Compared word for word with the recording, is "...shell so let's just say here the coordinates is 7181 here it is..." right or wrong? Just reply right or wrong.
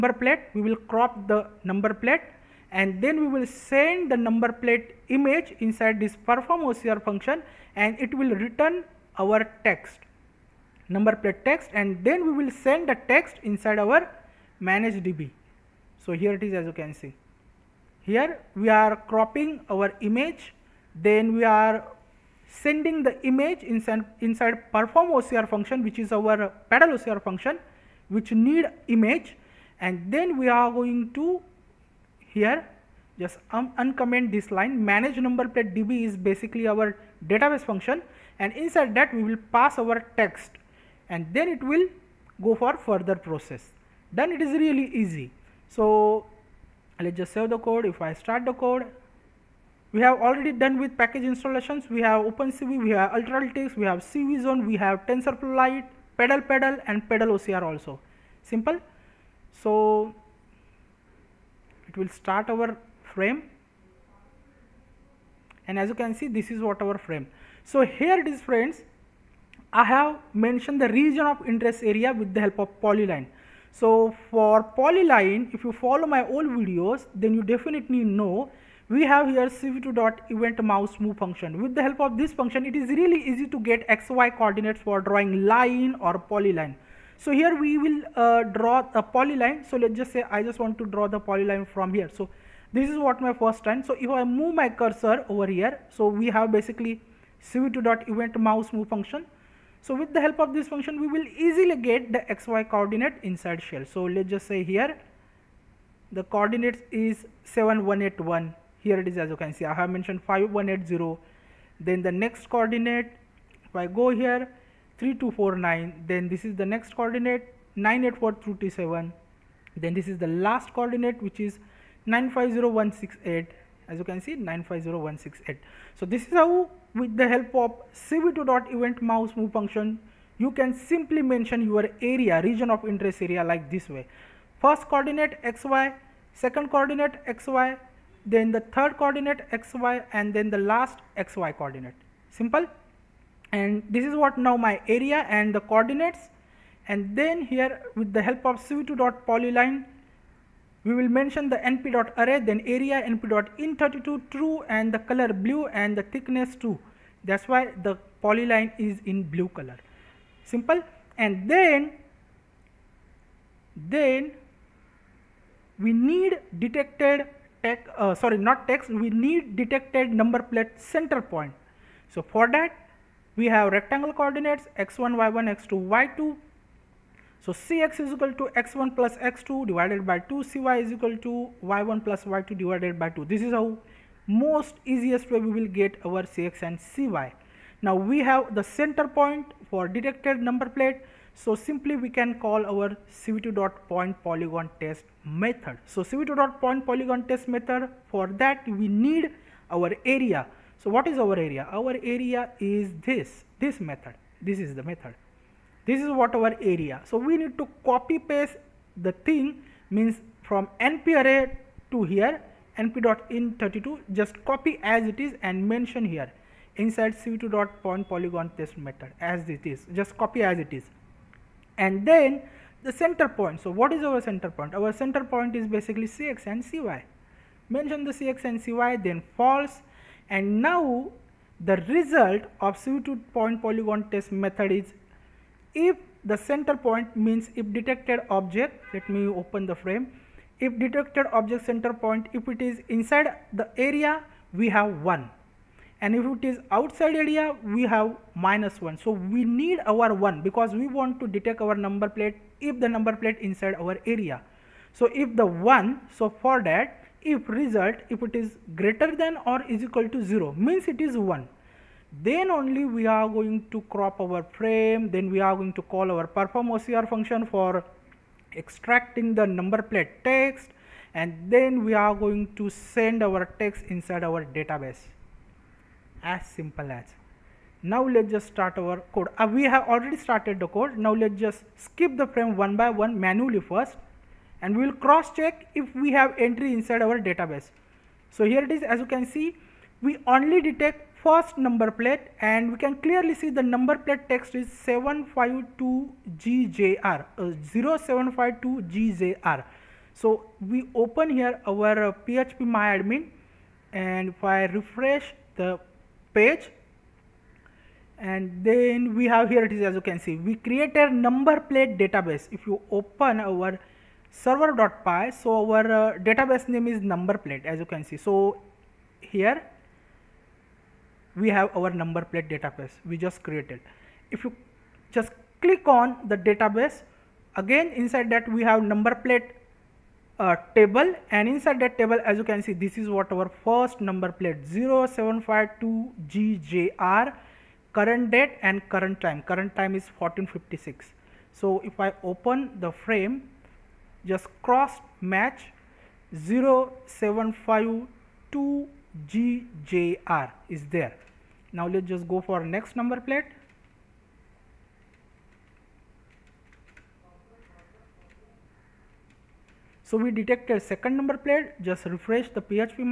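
right.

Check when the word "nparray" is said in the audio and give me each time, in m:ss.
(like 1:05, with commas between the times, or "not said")
2:31.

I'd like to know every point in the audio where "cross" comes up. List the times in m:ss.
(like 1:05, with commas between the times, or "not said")
4:45, 5:44.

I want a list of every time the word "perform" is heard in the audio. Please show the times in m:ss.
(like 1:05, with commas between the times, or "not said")
0:06, 0:24, 4:26.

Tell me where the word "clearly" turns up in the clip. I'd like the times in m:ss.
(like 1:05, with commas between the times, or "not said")
4:52.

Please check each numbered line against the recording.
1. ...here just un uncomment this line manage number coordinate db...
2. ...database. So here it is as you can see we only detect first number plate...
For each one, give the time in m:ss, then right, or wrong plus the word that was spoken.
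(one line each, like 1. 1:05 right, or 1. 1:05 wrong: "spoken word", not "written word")
1. 0:32 wrong: "plate", not "coordinate"
2. 4:47 right.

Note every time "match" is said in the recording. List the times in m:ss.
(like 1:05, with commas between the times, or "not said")
5:45.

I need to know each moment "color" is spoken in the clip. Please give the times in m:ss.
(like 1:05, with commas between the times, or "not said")
2:35, 2:39.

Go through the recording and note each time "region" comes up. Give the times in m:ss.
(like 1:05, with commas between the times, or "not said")
1:10, 2:12.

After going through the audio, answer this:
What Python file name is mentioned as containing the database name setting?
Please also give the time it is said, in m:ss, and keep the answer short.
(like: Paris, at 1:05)
server.py, at 5:14.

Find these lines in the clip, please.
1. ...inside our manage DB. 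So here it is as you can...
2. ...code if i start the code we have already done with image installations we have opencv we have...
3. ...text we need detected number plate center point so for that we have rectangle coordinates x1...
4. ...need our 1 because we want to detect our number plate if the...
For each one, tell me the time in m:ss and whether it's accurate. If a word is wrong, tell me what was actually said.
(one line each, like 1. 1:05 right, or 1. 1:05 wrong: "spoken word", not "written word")
1. 0:13 right
2. 0:47 wrong: "package", not "image"
3. 2:48 right
4. 4:09 right.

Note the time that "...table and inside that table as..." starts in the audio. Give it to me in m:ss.
5:30.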